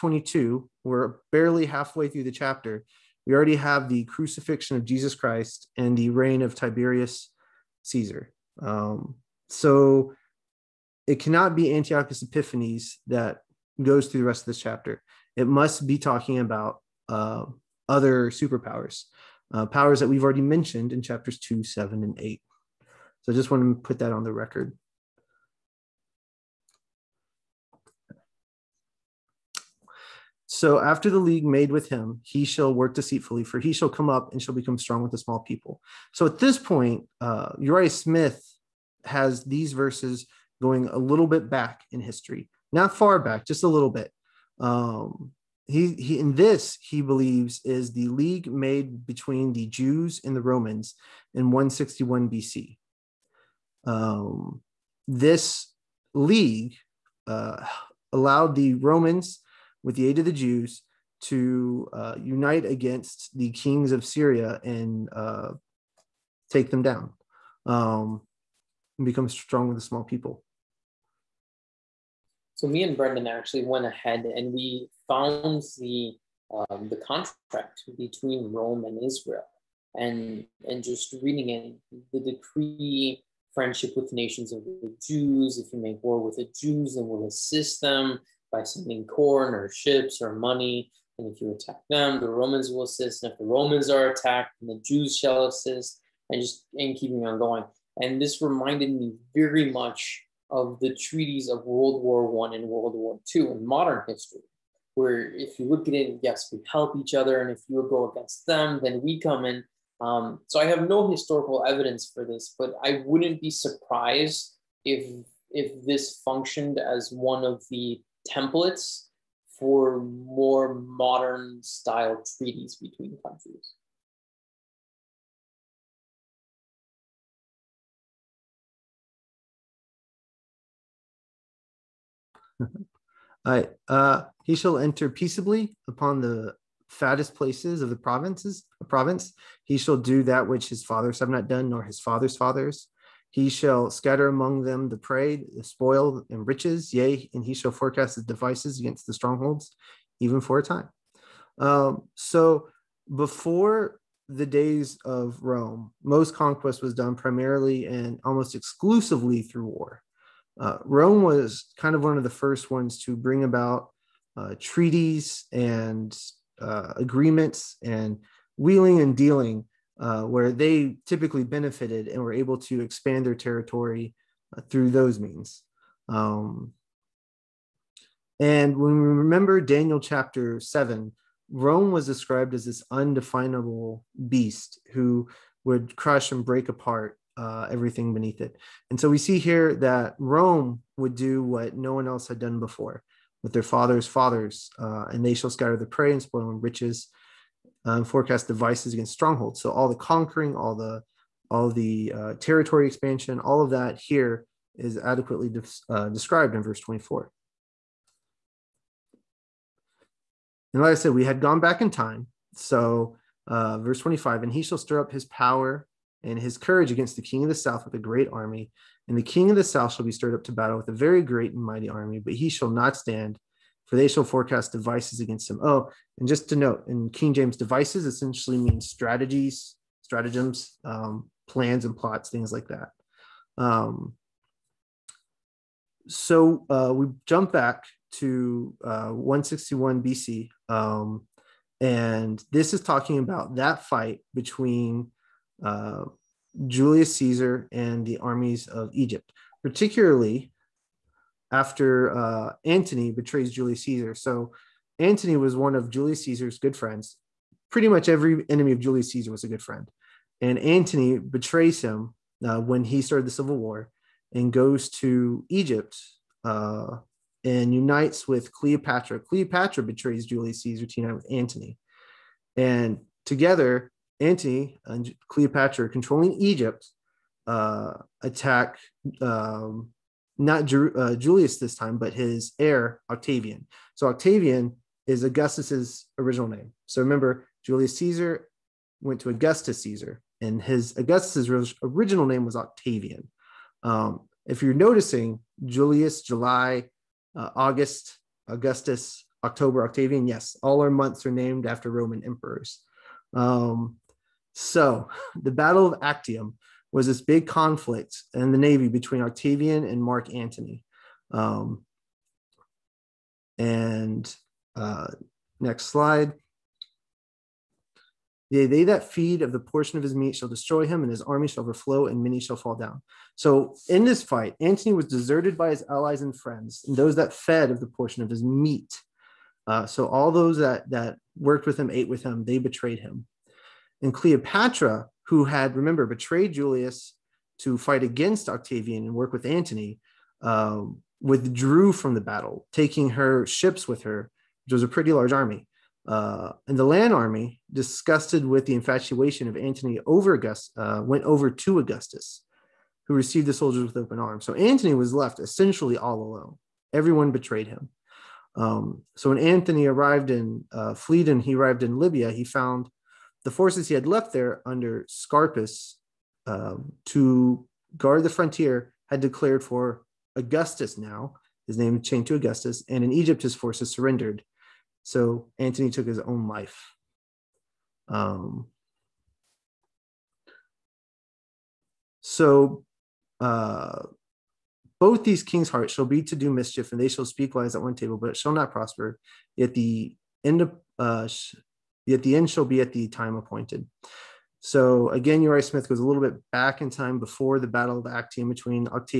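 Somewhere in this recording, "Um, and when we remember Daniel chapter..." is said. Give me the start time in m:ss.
2:56.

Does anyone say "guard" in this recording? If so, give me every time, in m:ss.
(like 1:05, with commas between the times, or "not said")
6:07.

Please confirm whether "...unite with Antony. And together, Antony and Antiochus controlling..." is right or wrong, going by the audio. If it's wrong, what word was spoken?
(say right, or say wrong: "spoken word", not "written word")
wrong: "Cleopatra", not "Antiochus".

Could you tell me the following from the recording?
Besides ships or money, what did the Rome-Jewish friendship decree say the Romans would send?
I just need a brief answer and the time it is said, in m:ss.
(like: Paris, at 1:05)
corn, at 1:29.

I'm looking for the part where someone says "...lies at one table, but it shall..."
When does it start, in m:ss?
6:27.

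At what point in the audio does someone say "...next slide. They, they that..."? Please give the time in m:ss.
5:15.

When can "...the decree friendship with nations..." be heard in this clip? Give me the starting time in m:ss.
1:22.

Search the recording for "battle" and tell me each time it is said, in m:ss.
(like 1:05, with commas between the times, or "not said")
3:40, 5:05, 5:42, 6:37.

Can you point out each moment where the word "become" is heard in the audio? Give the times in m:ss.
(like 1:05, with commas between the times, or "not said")
0:34, 1:09.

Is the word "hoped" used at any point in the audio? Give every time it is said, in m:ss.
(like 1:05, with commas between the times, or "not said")
not said.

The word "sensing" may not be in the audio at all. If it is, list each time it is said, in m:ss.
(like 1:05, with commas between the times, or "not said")
not said.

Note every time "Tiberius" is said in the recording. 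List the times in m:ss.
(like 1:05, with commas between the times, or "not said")
0:06.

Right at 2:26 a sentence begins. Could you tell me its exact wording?
Yea, and he shall forecast his devices against the strongholds, even for a time.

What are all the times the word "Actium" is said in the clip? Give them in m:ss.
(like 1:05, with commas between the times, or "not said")
5:06, 6:38.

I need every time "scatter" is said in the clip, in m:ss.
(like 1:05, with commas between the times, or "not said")
2:23, 3:15.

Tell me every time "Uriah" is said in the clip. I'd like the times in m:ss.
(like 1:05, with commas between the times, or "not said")
0:37, 6:35.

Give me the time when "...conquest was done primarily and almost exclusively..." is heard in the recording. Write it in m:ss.
2:36.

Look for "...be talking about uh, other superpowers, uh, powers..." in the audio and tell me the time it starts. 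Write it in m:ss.
0:15.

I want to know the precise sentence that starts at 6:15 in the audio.
So Antony took his own life.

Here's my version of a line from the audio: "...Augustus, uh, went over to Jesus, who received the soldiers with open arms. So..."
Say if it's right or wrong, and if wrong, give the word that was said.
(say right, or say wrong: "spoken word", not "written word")
wrong: "Augustus", not "Jesus".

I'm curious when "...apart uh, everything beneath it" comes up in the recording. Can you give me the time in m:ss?
3:06.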